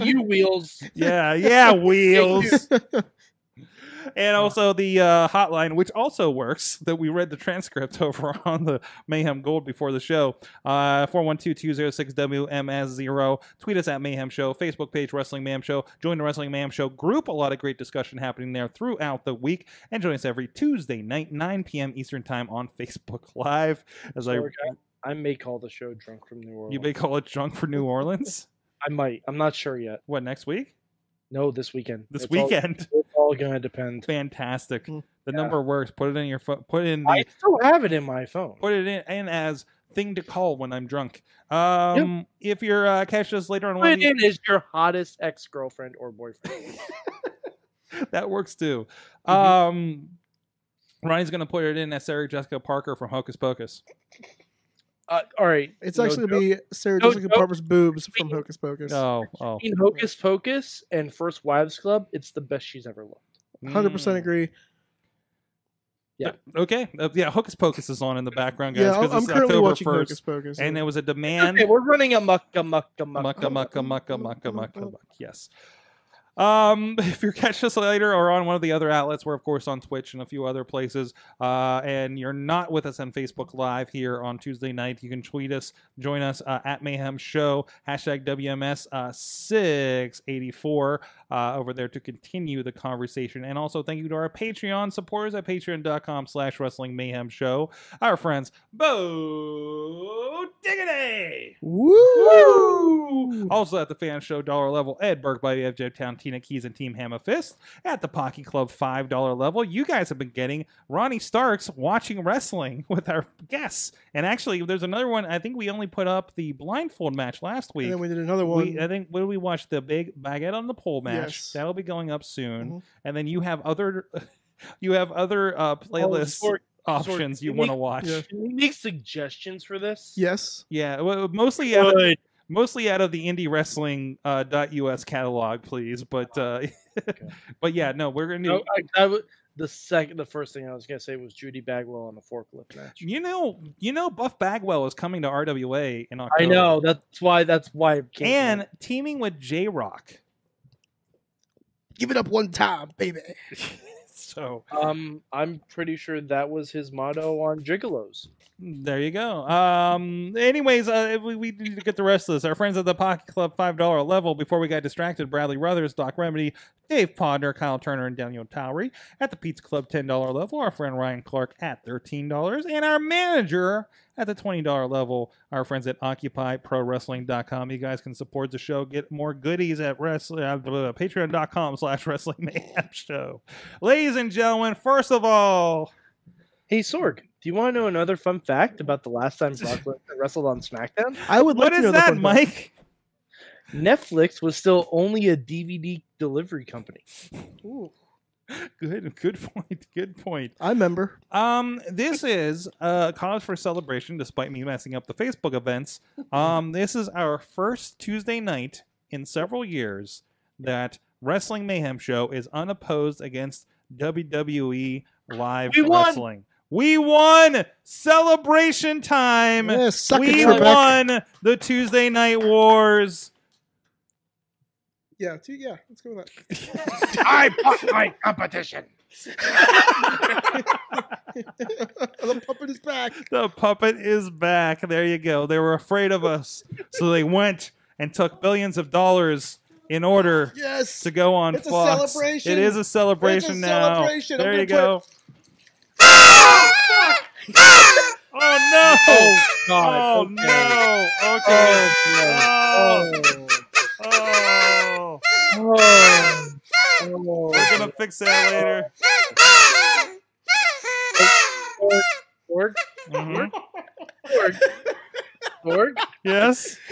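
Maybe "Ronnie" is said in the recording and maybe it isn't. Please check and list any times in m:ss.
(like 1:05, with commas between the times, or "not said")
0:51, 1:50.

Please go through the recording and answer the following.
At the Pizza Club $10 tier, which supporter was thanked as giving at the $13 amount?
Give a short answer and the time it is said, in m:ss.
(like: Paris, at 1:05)
Ryan Clark, at 2:50.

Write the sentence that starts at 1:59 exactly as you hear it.
The big baguette on the pole match.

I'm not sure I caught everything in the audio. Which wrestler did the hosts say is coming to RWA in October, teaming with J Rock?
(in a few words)
Buff Bagwell.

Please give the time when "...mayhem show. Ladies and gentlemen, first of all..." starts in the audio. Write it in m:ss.
3:02.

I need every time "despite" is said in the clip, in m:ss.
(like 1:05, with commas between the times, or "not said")
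3:24.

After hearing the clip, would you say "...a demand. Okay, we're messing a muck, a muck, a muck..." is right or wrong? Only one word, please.
wrong.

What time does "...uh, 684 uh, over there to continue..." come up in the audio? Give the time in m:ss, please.
1:28.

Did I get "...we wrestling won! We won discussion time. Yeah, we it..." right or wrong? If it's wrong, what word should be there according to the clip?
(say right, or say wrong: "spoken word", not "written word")
wrong: "celebration", not "discussion".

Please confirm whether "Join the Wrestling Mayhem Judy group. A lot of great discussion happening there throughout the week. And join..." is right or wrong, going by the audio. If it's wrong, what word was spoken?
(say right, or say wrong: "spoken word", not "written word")
wrong: "Show", not "Judy".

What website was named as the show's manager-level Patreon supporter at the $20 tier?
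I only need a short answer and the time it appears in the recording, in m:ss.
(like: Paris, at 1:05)
OccupyProWrestling.com, at 2:56.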